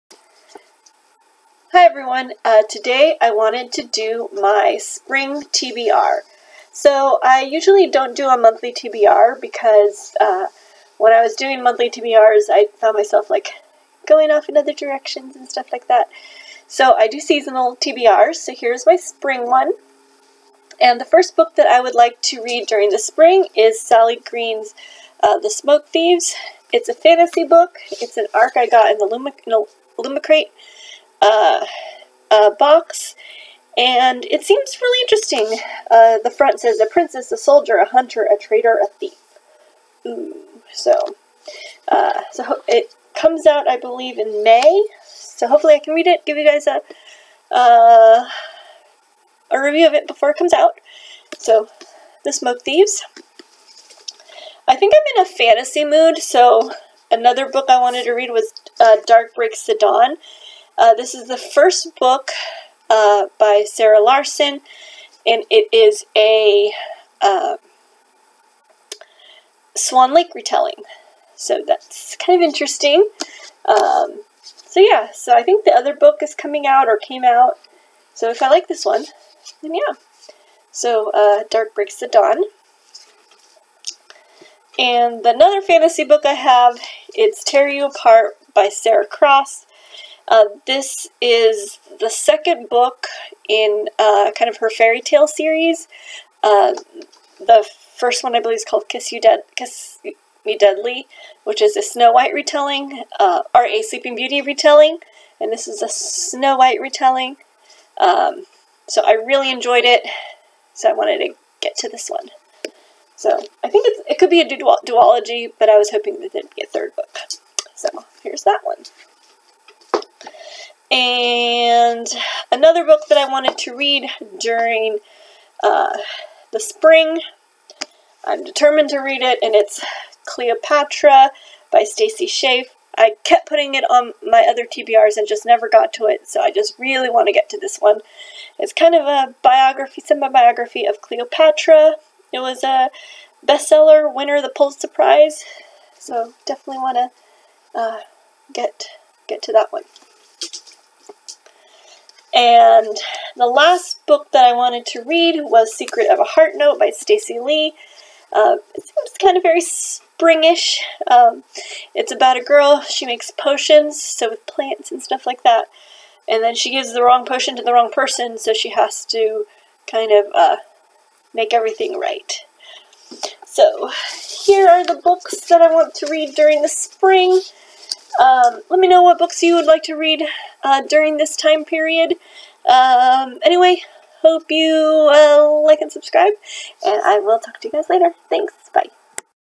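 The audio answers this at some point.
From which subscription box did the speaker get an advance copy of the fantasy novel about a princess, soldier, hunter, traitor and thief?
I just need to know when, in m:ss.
0:29.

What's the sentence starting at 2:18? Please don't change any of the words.
It's kind of a biography, semi-biography of Cleopatra.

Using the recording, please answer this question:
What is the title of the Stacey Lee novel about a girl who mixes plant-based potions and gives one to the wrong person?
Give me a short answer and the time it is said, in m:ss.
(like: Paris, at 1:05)
Secret of a Heart Note, at 2:35.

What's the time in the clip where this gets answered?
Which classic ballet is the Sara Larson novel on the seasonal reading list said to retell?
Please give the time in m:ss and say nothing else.
1:09.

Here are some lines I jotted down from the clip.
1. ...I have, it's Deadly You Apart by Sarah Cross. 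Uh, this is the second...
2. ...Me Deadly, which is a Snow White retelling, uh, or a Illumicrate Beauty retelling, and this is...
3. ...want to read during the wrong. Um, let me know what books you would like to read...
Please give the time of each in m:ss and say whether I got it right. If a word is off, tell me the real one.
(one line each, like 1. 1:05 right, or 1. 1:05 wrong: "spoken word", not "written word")
1. 1:26 wrong: "Tear", not "Deadly"
2. 1:40 wrong: "Sleeping", not "Illumicrate"
3. 2:55 wrong: "spring", not "wrong".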